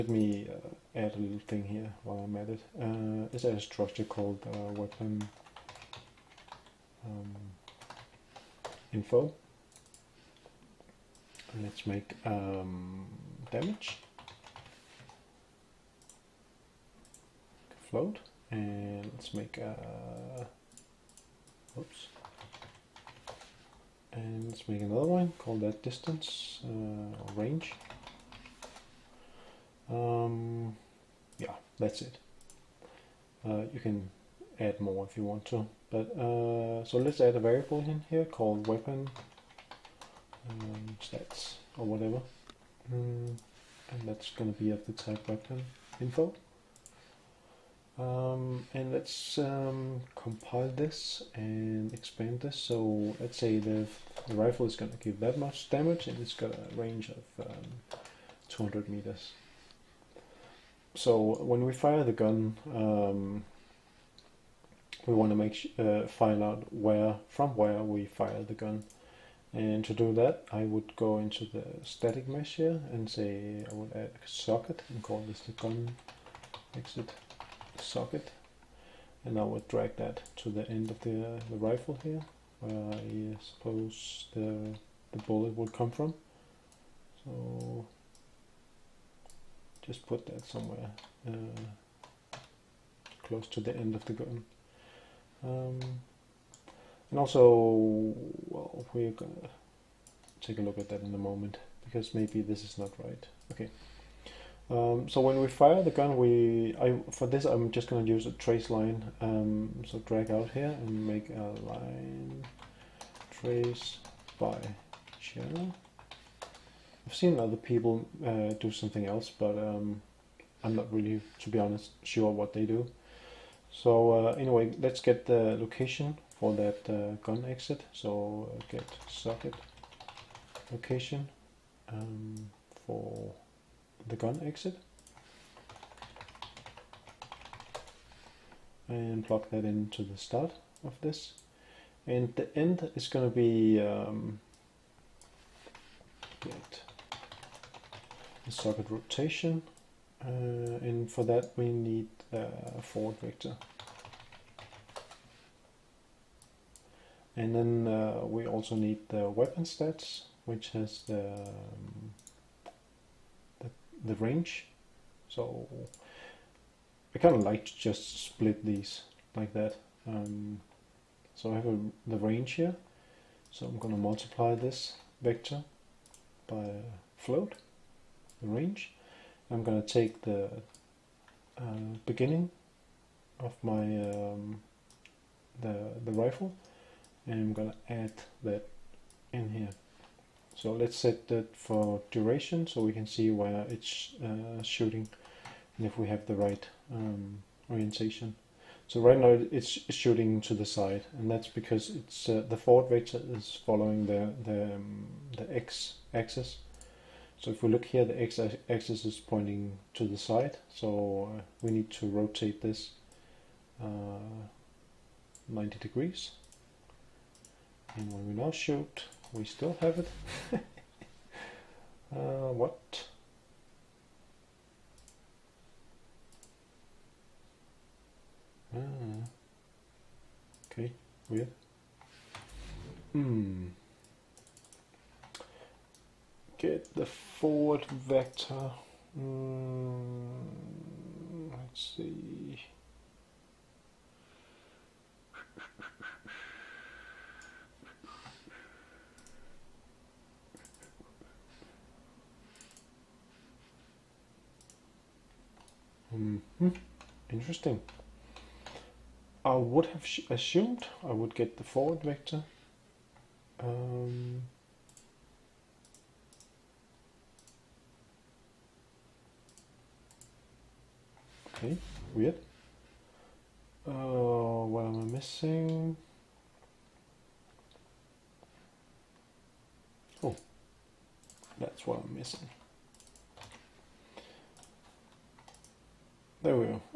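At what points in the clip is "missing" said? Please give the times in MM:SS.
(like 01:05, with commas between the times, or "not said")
04:35, 04:42.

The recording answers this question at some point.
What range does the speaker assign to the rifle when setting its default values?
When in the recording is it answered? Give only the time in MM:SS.
00:58.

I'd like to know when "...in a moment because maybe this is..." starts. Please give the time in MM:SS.
01:41.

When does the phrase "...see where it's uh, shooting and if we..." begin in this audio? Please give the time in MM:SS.
03:13.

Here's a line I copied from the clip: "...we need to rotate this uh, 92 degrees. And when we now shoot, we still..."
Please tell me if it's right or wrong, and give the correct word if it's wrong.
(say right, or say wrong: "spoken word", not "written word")
wrong: "90", not "92".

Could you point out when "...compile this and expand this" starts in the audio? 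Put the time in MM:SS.
00:50.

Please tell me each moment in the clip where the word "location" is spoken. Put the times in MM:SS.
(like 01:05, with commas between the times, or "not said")
02:05, 02:10.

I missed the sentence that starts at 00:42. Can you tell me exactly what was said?
Mm, and that's going to be of the type weapon info.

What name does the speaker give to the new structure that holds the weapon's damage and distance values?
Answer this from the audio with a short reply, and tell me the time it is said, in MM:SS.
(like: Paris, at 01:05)
weapon info, at 00:04.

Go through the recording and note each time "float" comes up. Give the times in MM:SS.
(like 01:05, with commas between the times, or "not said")
00:17, 02:57.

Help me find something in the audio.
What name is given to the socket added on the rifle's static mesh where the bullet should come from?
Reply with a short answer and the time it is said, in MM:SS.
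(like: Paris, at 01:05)
gun exit socket, at 01:15.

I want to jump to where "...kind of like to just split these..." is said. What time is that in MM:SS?
02:47.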